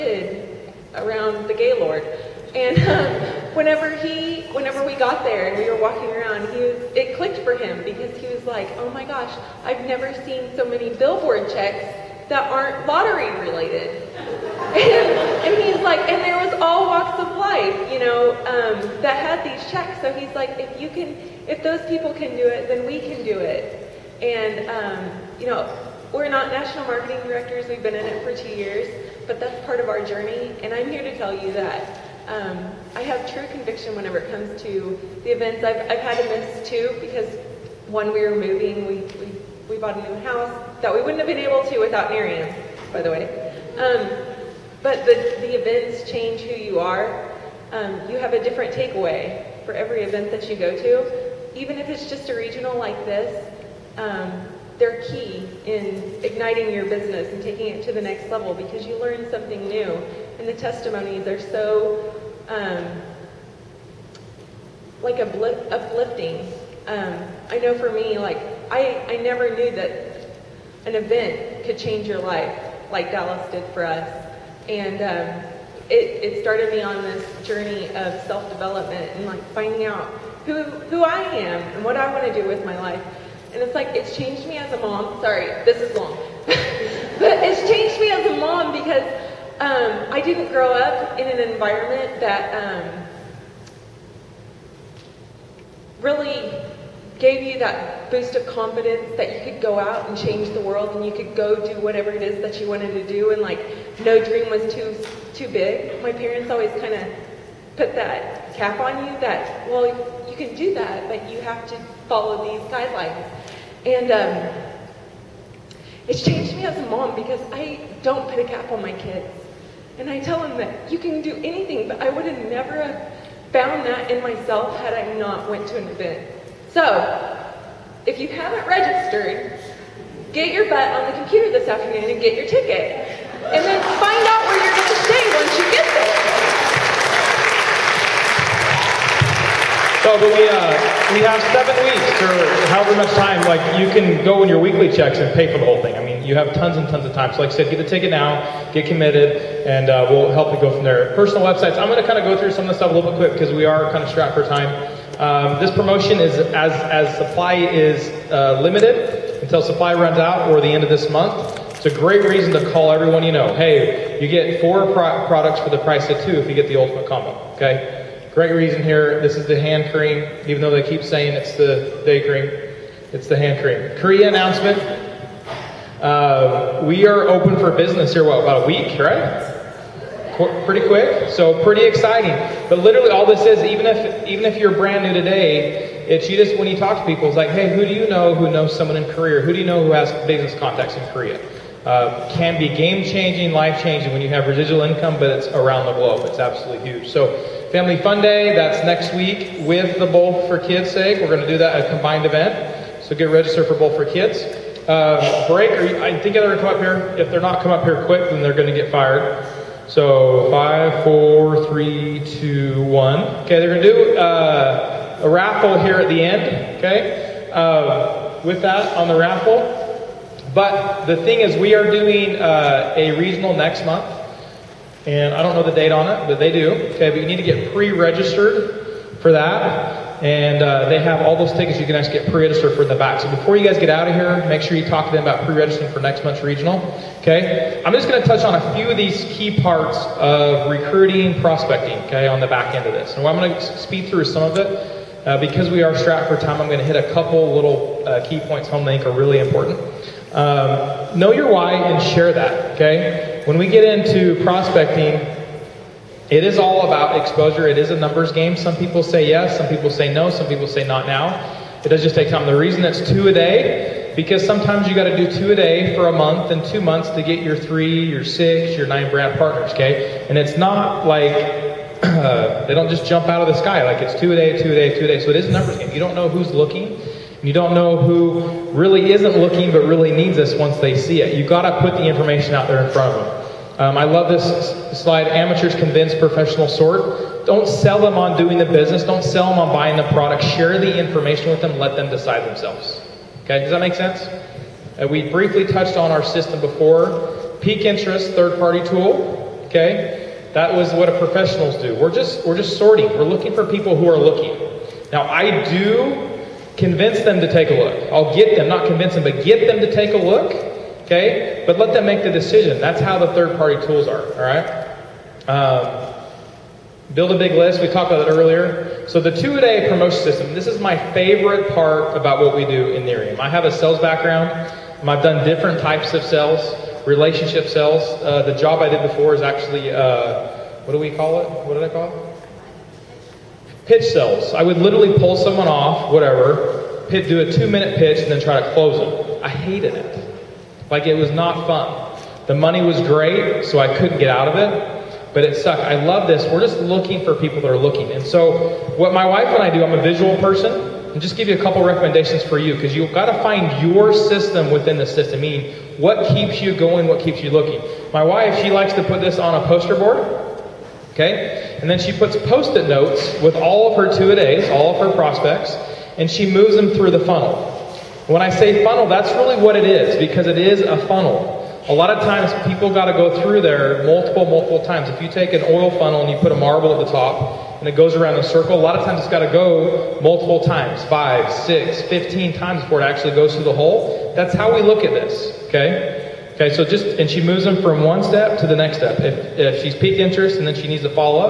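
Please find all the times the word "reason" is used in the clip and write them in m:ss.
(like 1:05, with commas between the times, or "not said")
2:42, 2:48, 4:22.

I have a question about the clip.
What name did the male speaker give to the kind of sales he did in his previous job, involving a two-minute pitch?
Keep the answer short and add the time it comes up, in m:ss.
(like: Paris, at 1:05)
Pitch sales, at 5:33.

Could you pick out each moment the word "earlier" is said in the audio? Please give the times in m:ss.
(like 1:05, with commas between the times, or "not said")
5:18.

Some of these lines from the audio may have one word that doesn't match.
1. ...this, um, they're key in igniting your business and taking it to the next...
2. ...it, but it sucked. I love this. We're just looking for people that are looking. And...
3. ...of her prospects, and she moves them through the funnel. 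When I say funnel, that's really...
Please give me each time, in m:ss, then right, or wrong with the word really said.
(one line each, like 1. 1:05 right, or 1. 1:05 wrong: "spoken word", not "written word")
1. 0:53 right
2. 5:44 right
3. 6:05 right.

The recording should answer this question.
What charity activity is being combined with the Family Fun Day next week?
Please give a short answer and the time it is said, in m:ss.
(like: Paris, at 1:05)
Bowl for Kids' sake, at 3:20.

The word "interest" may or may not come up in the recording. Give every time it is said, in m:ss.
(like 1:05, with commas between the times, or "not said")
4:57, 6:30.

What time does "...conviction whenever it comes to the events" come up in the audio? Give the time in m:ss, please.
0:33.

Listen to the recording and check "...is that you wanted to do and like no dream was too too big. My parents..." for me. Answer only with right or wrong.
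right.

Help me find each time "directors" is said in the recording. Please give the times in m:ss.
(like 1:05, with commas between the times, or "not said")
0:27.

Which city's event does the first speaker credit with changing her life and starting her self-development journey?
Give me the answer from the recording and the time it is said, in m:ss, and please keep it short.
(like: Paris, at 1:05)
Dallas, at 1:13.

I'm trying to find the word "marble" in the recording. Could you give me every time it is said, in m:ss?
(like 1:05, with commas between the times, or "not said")
6:16.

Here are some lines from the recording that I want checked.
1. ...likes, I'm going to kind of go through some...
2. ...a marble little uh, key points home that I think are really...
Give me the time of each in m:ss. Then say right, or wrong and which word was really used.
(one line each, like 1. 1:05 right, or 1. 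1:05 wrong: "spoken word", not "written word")
1. 2:31 wrong: "websites", not "likes"
2. 4:06 wrong: "couple", not "marble".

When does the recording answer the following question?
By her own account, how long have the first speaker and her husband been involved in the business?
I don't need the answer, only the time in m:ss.
0:28.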